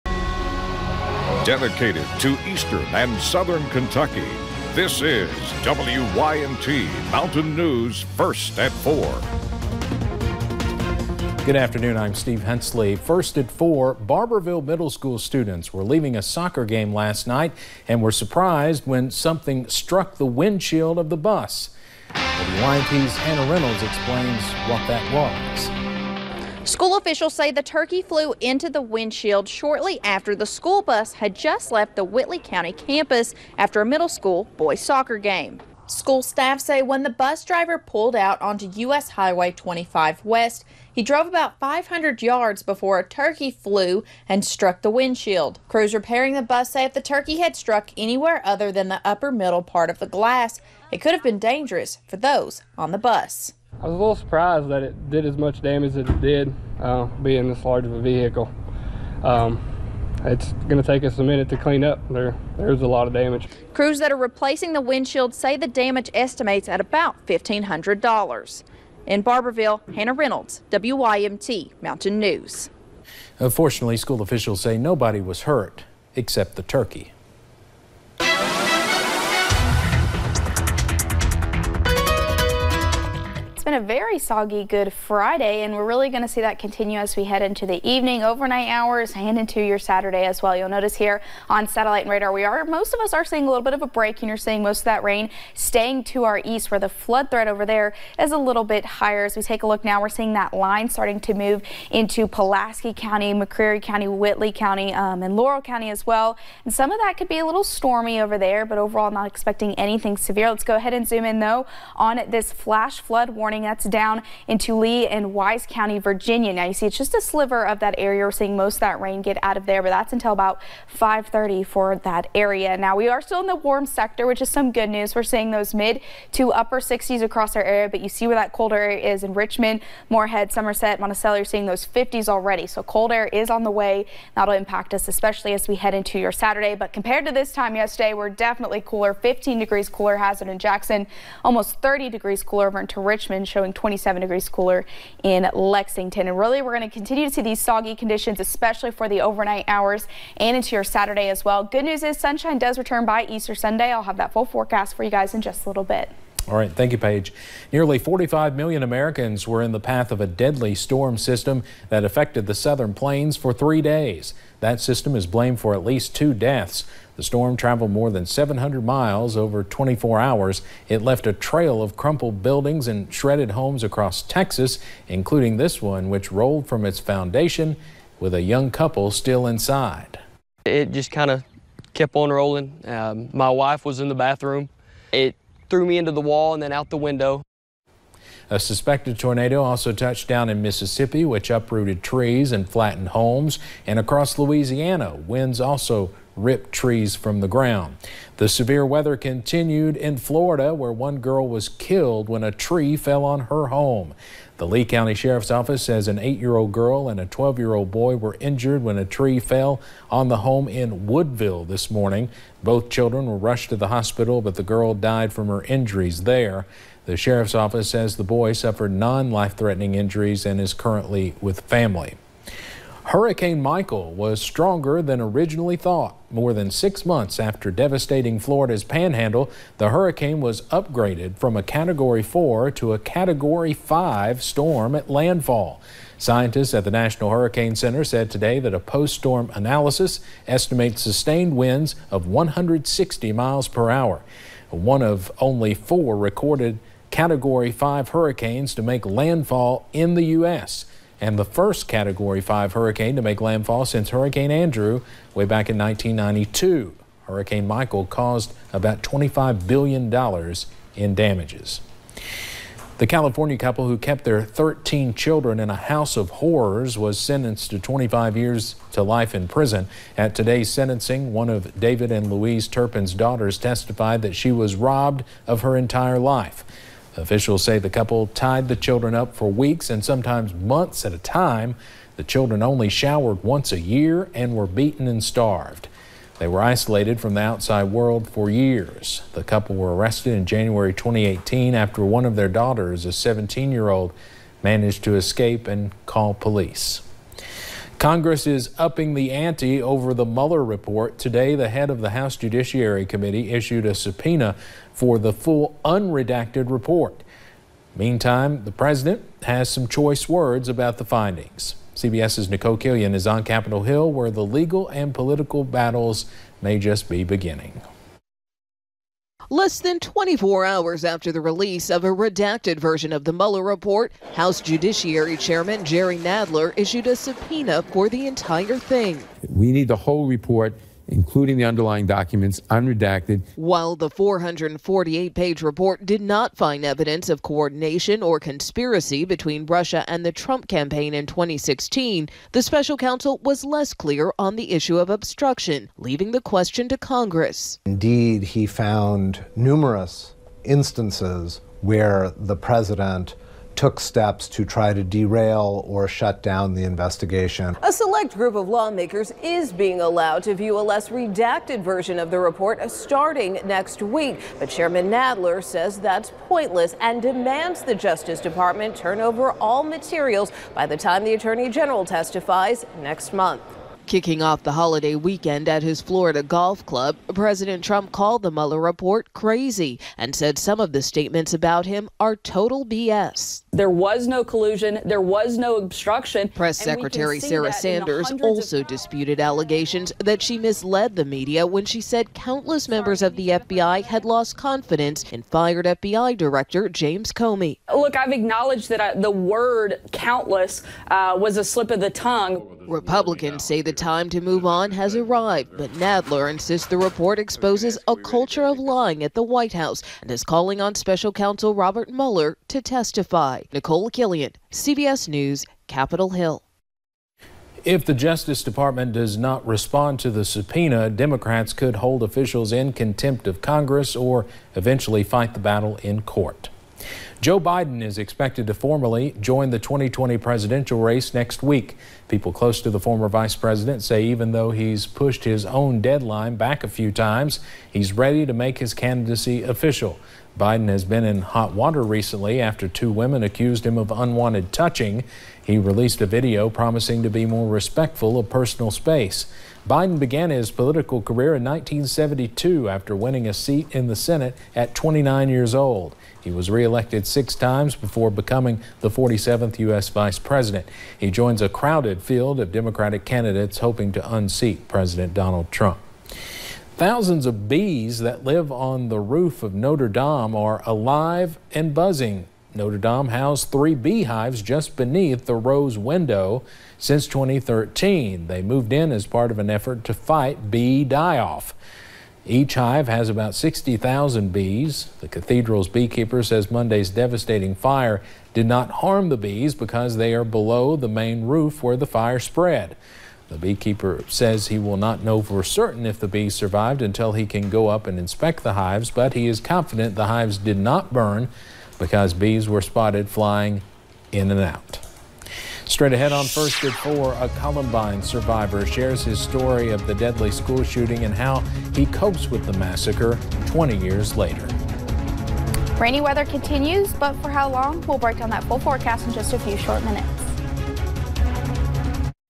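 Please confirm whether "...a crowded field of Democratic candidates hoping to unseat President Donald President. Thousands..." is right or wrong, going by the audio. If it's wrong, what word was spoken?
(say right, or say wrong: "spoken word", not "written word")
wrong: "Trump", not "President".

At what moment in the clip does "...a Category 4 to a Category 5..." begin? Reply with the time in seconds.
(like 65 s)
231 s.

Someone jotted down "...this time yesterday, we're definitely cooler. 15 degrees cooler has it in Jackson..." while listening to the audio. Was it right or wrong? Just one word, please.
right.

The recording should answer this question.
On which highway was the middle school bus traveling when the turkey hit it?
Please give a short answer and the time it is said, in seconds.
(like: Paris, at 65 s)
U.S. Highway 25 West, at 38 s.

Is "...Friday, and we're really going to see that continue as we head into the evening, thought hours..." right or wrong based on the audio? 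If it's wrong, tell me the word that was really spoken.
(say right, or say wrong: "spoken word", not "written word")
wrong: "overnight", not "thought".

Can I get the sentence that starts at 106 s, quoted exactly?
And some of that could be a little stormy over there, but overall, not expecting anything severe.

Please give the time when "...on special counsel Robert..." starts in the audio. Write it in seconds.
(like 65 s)
410 s.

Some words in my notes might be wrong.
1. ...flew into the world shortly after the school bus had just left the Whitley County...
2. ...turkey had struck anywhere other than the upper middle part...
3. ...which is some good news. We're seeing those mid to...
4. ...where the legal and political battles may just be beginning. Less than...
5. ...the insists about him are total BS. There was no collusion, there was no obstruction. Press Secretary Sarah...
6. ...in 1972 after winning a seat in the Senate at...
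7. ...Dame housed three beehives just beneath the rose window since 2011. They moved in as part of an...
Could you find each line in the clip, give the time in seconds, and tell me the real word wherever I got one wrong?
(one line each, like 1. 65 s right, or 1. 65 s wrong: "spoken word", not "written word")
1. 28 s wrong: "windshield", not "world"
2. 47 s right
3. 124 s right
4. 314 s right
5. 380 s wrong: "statements", not "insists"
6. 451 s right
7. 472 s wrong: "2013", not "2011".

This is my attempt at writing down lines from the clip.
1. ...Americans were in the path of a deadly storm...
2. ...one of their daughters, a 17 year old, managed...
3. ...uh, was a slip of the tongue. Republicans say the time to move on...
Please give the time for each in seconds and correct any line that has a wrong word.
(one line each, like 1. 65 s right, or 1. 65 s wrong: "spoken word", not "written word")
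1. 158 s right
2. 292 s right
3. 401 s right.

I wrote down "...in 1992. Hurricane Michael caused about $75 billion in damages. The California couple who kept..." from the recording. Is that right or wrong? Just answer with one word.
wrong.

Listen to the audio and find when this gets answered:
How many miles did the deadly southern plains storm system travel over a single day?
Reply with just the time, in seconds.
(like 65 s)
168 s.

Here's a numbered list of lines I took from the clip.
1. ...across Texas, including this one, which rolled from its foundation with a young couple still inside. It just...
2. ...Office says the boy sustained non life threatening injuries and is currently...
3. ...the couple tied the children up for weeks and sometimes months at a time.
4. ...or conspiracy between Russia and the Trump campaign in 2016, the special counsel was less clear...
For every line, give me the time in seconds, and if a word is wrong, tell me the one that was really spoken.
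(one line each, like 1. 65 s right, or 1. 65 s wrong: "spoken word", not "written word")
1. 173 s right
2. 217 s wrong: "suffered", not "sustained"
3. 277 s right
4. 338 s right.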